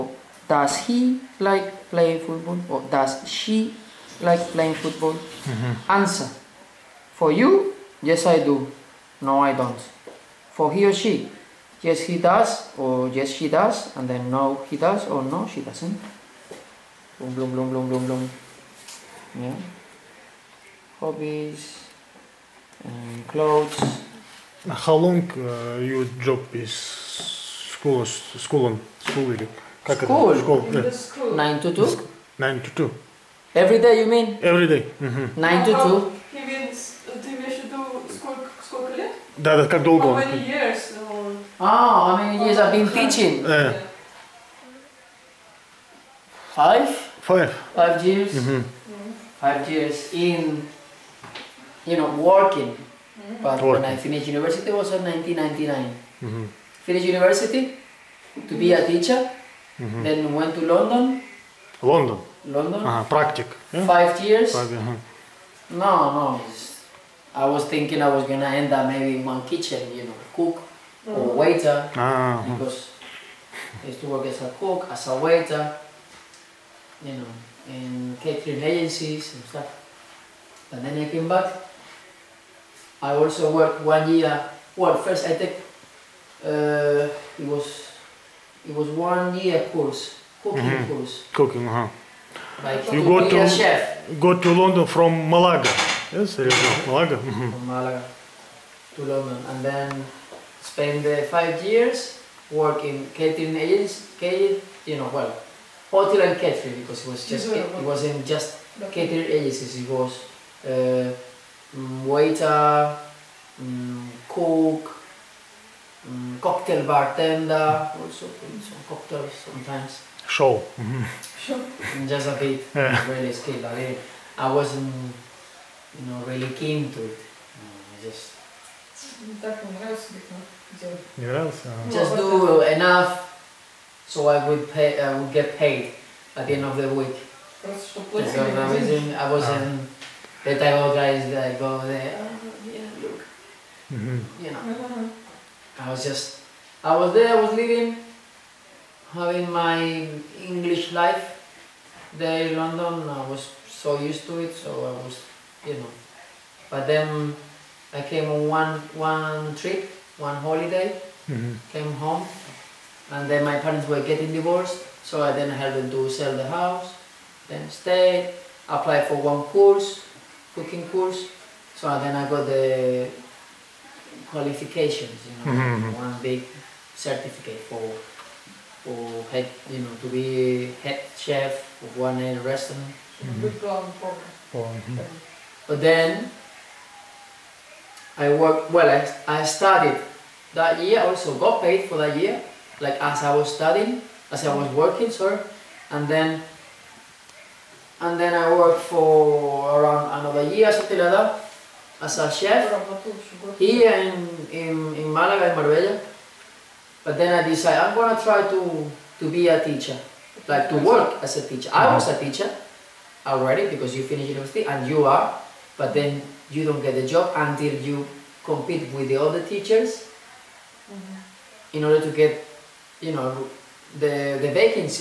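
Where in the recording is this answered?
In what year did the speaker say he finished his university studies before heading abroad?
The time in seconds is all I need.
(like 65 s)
55 s.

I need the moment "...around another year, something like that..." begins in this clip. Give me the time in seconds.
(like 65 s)
199 s.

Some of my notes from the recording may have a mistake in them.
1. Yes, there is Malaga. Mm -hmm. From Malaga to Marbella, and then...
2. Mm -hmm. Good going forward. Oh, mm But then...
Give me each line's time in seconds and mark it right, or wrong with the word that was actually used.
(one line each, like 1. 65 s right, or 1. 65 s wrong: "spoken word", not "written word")
1. 96 s wrong: "London", not "Marbella"
2. 182 s right.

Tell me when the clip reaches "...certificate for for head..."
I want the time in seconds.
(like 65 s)
176 s.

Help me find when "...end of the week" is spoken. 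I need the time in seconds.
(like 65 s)
136 s.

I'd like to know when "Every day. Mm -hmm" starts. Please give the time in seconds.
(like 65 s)
34 s.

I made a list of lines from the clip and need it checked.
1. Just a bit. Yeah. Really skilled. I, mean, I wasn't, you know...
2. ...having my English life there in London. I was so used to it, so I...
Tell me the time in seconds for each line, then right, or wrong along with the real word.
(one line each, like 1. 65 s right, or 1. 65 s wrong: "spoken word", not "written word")
1. 122 s right
2. 149 s right.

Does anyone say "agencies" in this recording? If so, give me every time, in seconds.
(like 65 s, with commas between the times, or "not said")
78 s, 109 s.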